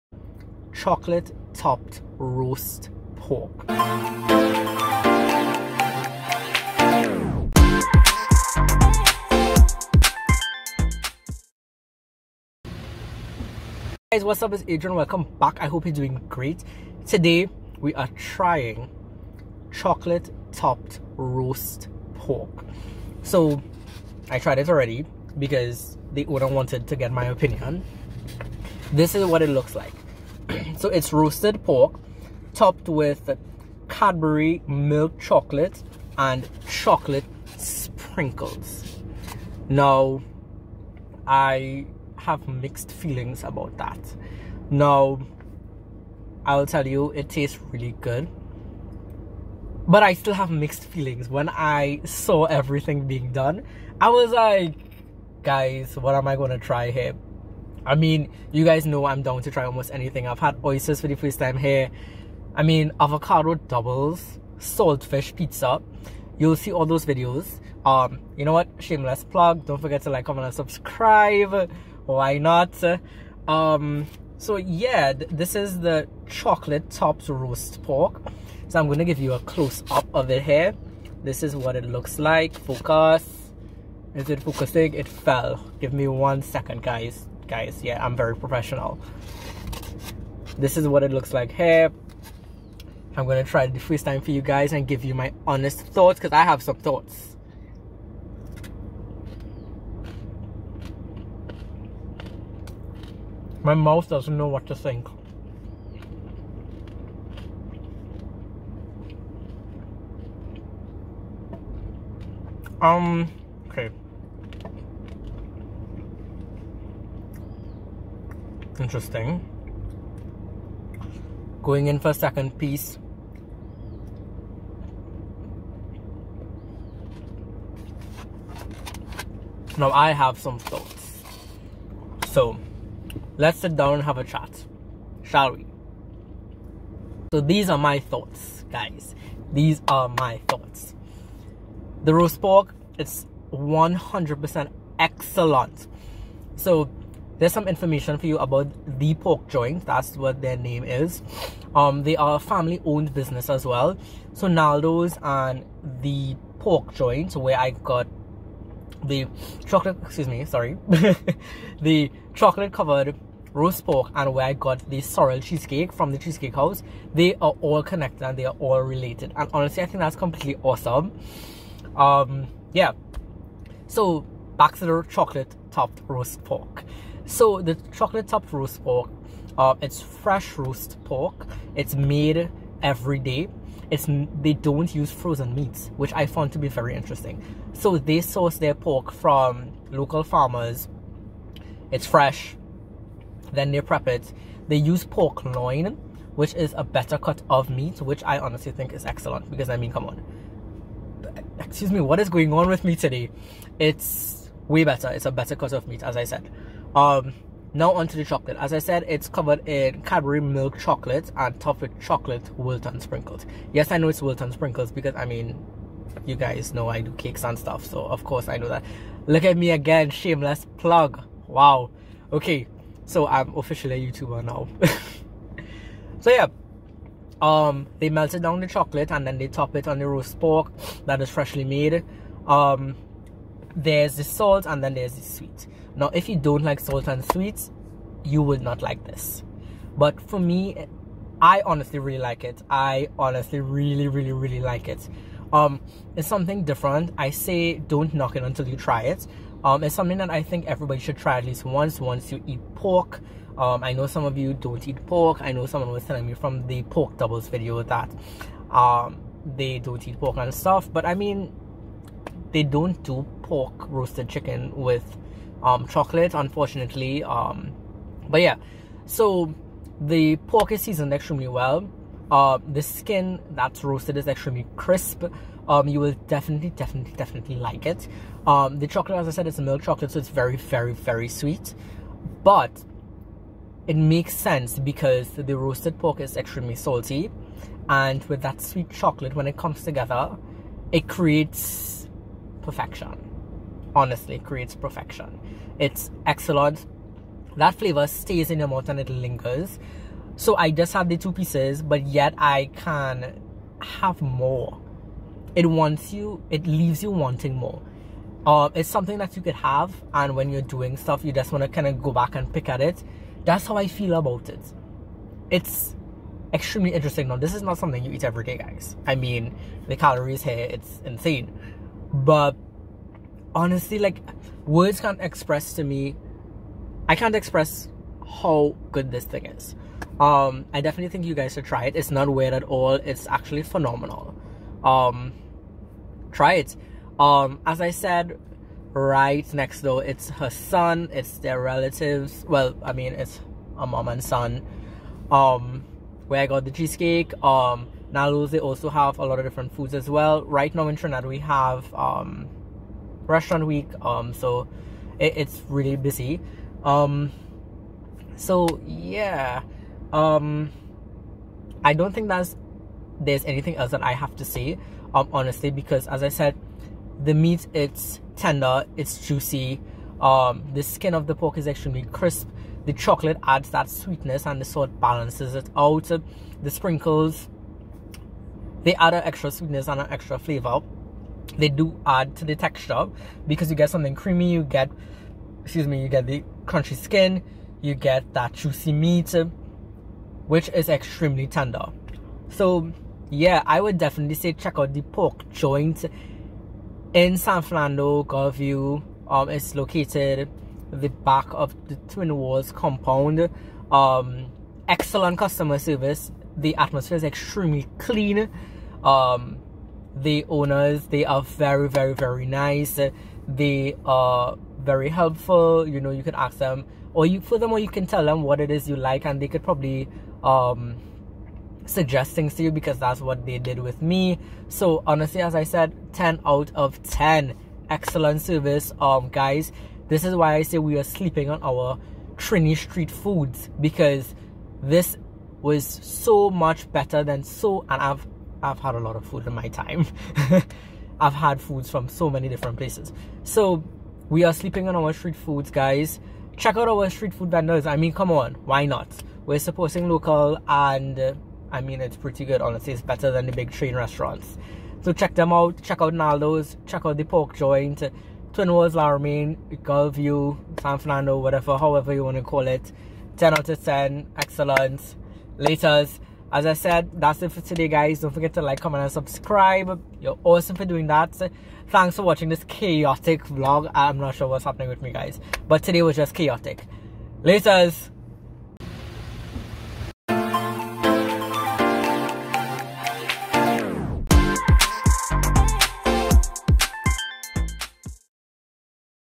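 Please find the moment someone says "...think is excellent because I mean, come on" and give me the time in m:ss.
3:18.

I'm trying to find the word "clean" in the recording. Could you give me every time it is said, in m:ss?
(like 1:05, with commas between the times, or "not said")
6:47.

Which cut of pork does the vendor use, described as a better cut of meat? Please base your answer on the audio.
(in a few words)
Pork loin.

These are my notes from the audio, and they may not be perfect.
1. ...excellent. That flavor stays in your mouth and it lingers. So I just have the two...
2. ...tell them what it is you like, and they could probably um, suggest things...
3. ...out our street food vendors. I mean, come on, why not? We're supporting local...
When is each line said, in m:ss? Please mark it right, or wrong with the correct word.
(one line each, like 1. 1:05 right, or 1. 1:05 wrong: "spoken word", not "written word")
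1. 4:56 right
2. 6:58 right
3. 7:26 right.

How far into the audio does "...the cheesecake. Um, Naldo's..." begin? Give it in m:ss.
5:46.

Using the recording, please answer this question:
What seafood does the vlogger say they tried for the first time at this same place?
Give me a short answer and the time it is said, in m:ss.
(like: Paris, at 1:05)
Oysters, at 1:00.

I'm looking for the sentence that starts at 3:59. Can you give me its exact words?
But for me, I honestly really like it.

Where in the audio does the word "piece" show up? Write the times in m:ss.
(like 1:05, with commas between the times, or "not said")
2:02, 5:01.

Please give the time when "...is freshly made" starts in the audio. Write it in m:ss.
3:51.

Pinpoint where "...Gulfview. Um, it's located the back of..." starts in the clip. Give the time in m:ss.
6:38.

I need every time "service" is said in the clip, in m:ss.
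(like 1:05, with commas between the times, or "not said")
6:45, 7:08.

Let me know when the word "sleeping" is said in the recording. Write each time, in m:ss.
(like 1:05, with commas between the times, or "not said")
7:11, 7:24.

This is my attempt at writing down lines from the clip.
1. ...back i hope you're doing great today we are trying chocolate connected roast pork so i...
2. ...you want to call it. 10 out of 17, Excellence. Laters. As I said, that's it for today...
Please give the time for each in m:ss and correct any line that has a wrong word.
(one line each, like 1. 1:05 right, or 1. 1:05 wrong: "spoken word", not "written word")
1. 0:15 wrong: "topped", not "connected"
2. 7:42 wrong: "10", not "17".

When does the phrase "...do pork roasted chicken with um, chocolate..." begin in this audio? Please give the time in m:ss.
4:23.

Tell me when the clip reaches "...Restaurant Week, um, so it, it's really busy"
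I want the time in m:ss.
5:53.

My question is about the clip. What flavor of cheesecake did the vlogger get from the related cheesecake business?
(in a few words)
Sorrel.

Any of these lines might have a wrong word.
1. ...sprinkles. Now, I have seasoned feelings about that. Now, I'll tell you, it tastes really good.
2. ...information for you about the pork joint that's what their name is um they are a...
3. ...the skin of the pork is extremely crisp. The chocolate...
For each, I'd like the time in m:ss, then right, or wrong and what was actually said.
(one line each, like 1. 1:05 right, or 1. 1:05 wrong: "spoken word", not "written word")
1. 0:37 wrong: "mixed", not "seasoned"
2. 2:27 right
3. 6:10 right.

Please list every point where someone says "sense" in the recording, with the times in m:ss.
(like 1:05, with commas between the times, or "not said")
4:44.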